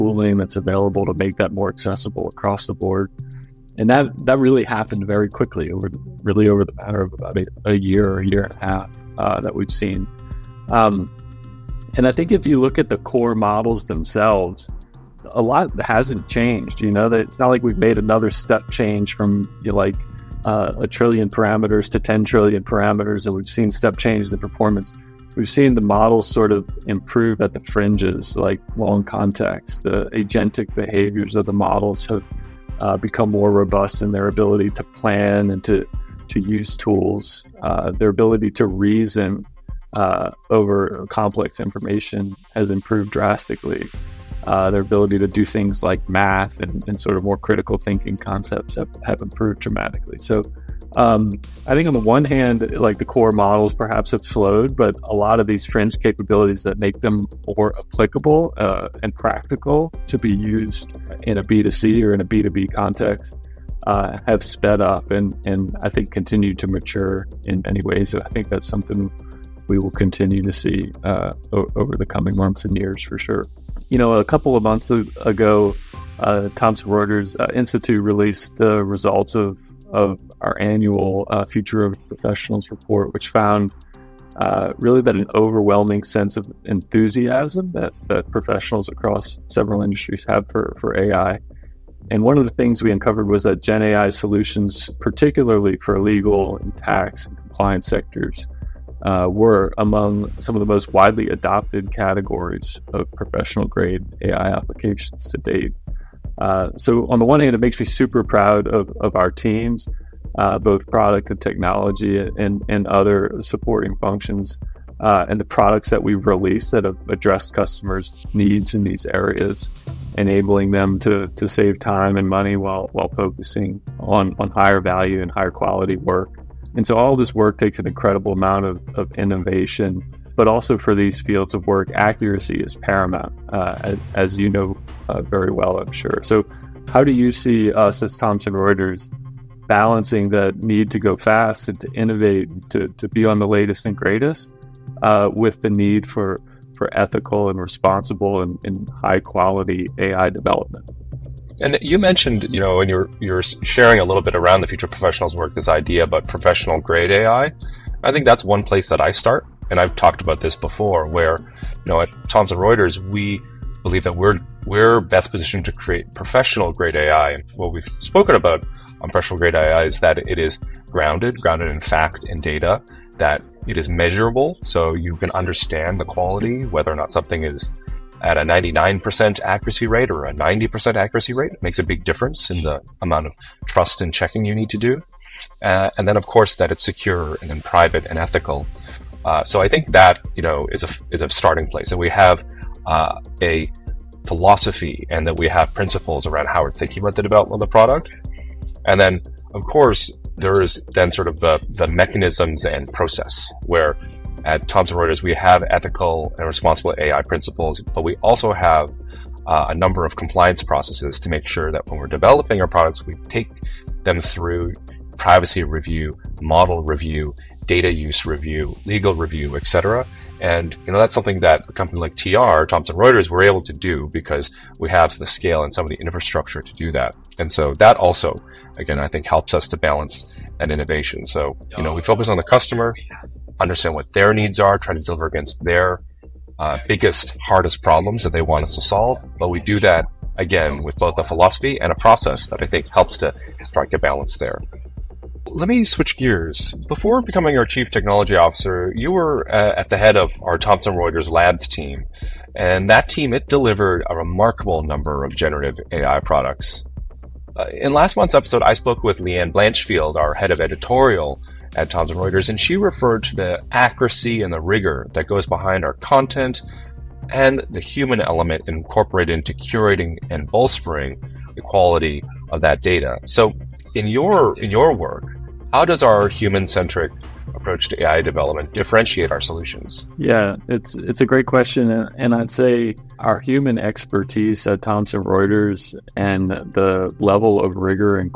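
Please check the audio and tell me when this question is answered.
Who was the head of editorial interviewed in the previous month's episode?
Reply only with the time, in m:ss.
4:19.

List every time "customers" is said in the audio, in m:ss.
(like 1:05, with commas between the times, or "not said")
1:57, 3:52.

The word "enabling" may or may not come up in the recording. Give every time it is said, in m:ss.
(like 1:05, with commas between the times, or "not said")
2:00.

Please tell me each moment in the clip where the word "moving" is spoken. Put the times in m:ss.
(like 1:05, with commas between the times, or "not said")
not said.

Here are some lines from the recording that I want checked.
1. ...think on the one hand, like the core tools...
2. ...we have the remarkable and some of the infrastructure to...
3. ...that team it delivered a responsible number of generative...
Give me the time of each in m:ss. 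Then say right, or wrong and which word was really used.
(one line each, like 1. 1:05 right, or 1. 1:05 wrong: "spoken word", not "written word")
1. 0:51 wrong: "models", not "tools"
2. 3:44 wrong: "scale", not "remarkable"
3. 4:12 wrong: "remarkable", not "responsible".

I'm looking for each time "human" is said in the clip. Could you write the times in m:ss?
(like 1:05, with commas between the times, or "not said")
4:27, 4:36, 4:43.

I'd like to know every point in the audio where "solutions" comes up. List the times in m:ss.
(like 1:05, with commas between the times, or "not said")
1:34, 4:39.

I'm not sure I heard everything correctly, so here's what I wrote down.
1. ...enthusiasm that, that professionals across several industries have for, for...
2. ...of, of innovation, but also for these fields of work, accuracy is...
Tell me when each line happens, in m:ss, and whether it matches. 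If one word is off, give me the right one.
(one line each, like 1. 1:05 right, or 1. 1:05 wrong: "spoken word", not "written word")
1. 1:26 right
2. 2:08 right.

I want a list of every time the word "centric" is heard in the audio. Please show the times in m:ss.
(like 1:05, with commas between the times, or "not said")
4:36.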